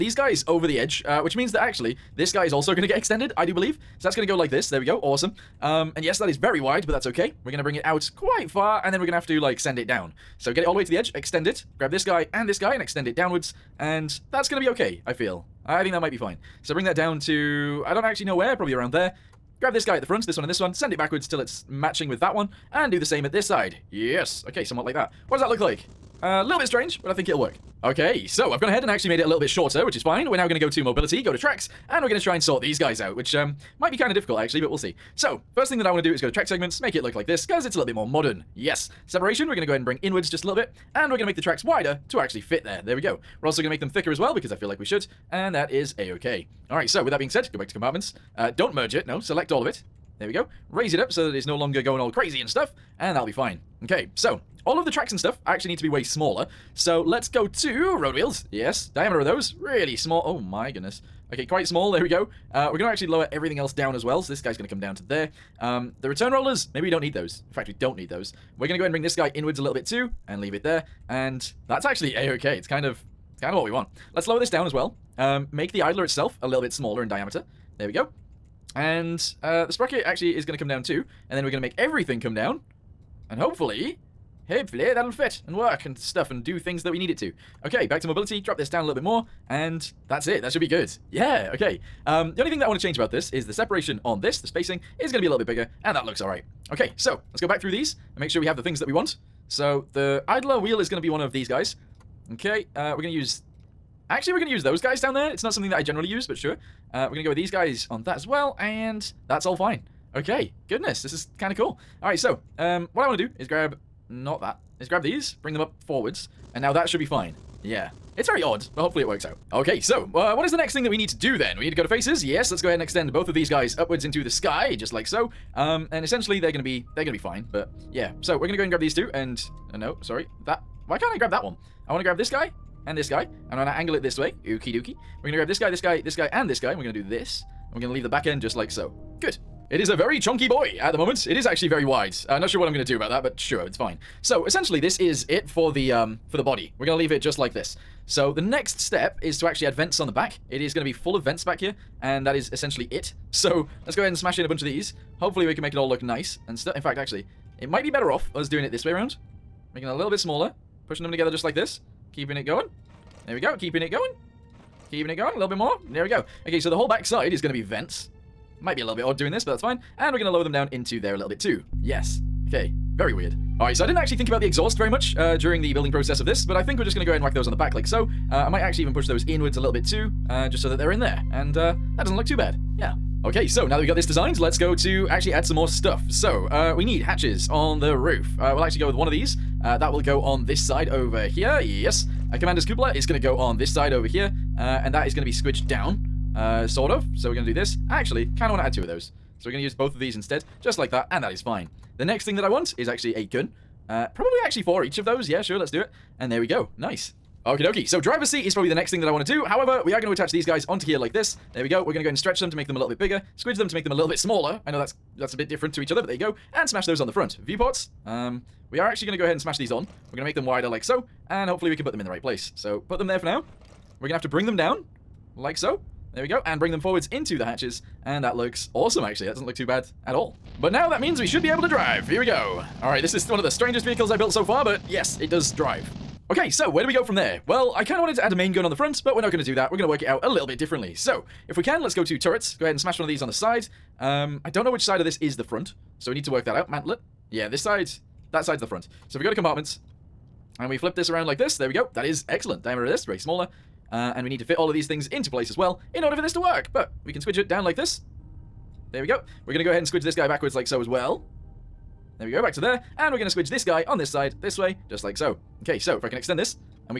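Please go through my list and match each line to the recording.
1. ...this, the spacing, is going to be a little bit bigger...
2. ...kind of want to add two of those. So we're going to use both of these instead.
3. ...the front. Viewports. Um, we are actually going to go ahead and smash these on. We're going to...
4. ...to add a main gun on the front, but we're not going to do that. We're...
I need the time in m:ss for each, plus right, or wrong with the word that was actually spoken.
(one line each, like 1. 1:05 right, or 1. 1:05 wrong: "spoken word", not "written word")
1. 1:34 right
2. 3:18 right
3. 3:37 right
4. 3:58 right.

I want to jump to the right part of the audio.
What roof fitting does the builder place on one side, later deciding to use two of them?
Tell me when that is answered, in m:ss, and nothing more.
3:12.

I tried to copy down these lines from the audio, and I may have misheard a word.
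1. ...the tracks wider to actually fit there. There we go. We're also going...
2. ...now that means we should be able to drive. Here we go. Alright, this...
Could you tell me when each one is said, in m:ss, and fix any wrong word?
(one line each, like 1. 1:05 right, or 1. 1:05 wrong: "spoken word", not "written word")
1. 0:41 right
2. 3:50 right.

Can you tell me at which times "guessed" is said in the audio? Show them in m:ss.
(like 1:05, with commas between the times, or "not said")
not said.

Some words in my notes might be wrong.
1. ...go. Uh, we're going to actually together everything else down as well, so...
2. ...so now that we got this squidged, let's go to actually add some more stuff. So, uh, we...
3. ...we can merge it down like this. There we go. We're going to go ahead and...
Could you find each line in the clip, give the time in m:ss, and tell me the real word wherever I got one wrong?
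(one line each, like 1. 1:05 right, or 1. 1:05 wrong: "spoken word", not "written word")
1. 1:02 wrong: "lower", not "together"
2. 3:03 wrong: "designed", not "squidged"
3. 4:17 wrong: "squidge", not "merge".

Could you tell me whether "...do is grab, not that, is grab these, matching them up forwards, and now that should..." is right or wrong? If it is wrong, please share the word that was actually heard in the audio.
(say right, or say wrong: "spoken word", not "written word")
wrong: "bring", not "matching".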